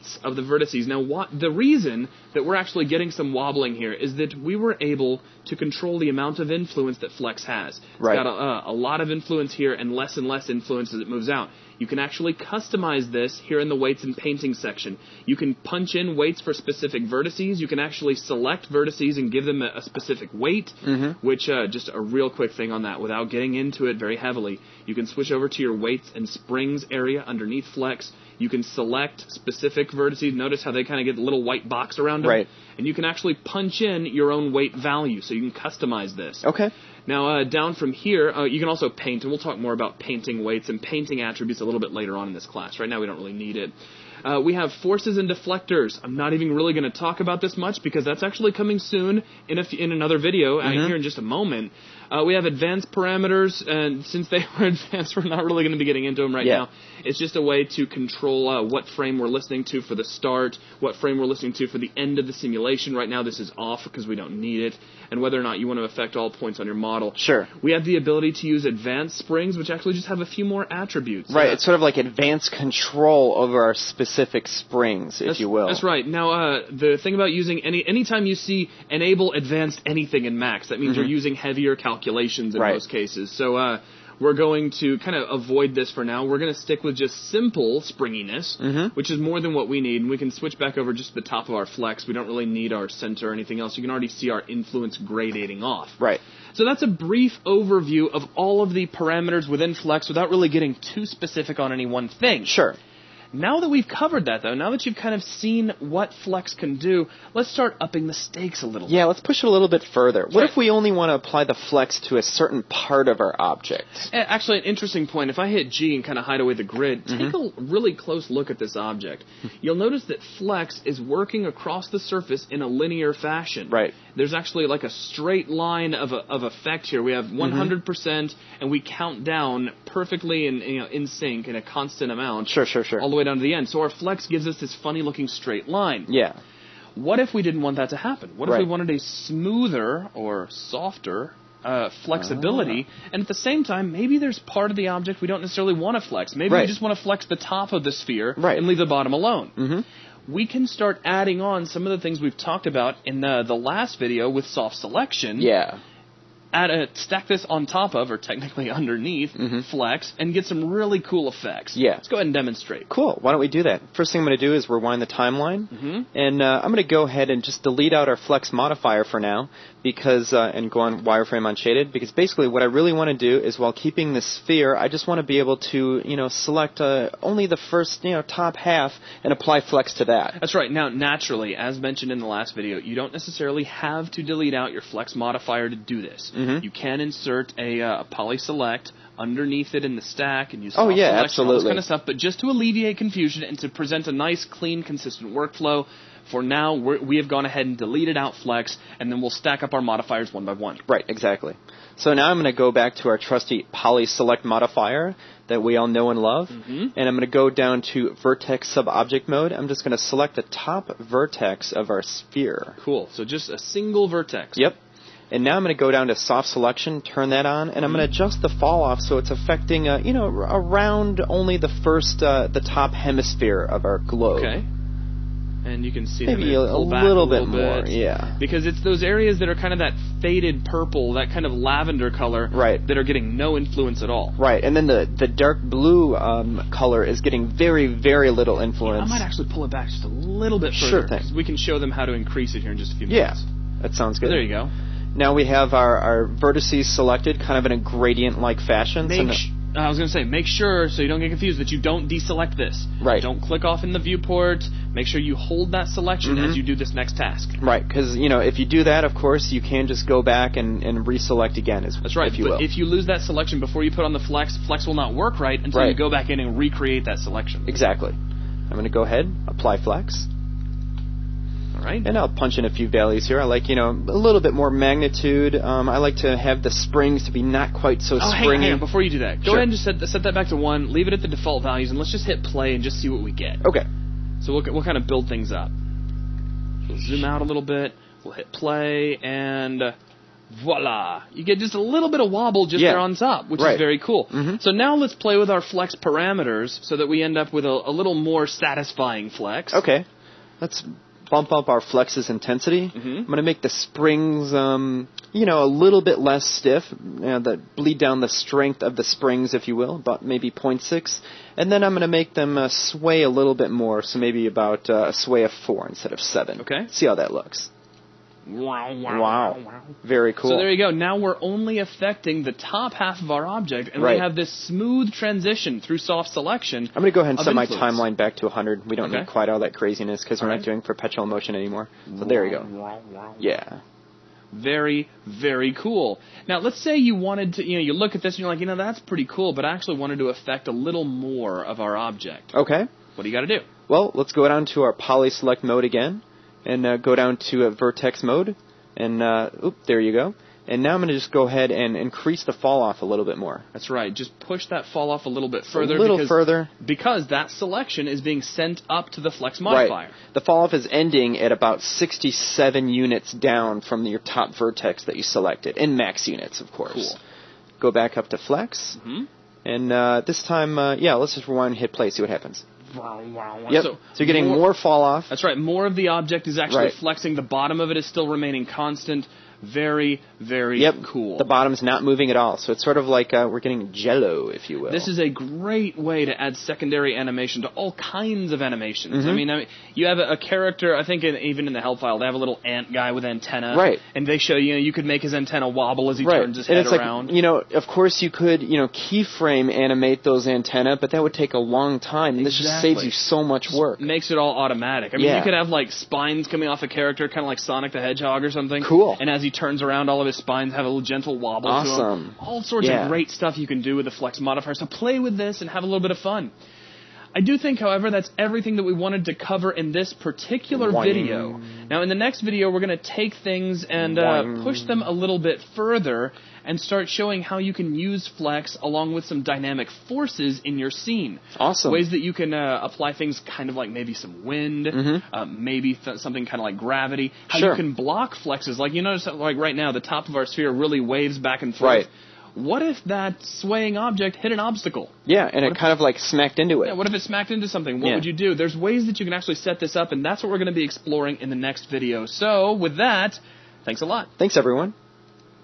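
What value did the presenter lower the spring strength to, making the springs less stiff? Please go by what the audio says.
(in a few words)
0.6.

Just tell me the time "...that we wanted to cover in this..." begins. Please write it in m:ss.
6:58.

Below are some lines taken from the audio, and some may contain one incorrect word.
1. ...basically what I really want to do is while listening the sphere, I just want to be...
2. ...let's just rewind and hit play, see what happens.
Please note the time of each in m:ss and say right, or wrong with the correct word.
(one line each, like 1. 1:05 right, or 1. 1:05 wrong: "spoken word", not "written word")
1. 2:52 wrong: "keeping", not "listening"
2. 6:11 right.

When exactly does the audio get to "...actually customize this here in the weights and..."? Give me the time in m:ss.
0:11.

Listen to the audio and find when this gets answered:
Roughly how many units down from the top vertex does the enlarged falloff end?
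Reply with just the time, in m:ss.
6:01.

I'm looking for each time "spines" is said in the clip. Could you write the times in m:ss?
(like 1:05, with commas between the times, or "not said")
6:45, 6:50.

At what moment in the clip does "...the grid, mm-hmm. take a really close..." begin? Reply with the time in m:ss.
1:56.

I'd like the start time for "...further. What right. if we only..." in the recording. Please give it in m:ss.
1:49.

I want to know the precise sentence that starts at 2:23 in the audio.
and at the same time, maybe there's part of the object we don't necessarily want to flex.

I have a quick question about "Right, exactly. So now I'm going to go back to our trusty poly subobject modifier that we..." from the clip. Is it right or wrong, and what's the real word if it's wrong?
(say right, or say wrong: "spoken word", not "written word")
wrong: "select", not "subobject".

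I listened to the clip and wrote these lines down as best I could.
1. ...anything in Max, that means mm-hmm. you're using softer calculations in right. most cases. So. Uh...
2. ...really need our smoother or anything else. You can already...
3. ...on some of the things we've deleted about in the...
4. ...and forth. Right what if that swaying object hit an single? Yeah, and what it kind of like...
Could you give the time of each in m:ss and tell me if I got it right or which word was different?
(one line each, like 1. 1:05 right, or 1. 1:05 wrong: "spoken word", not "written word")
1. 1:19 wrong: "heavier", not "softer"
2. 1:32 wrong: "center", not "smoother"
3. 2:31 wrong: "talked", not "deleted"
4. 7:21 wrong: "obstacle", not "single".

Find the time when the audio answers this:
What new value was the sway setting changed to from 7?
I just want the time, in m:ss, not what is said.
5:15.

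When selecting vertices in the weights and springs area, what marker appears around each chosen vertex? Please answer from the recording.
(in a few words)
little white box.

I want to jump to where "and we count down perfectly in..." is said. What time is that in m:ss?
2:08.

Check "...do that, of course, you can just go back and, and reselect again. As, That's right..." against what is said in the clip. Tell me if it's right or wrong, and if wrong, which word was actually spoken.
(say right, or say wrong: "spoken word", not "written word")
right.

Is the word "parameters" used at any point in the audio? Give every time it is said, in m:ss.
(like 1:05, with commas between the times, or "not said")
0:52, 1:38, 4:55.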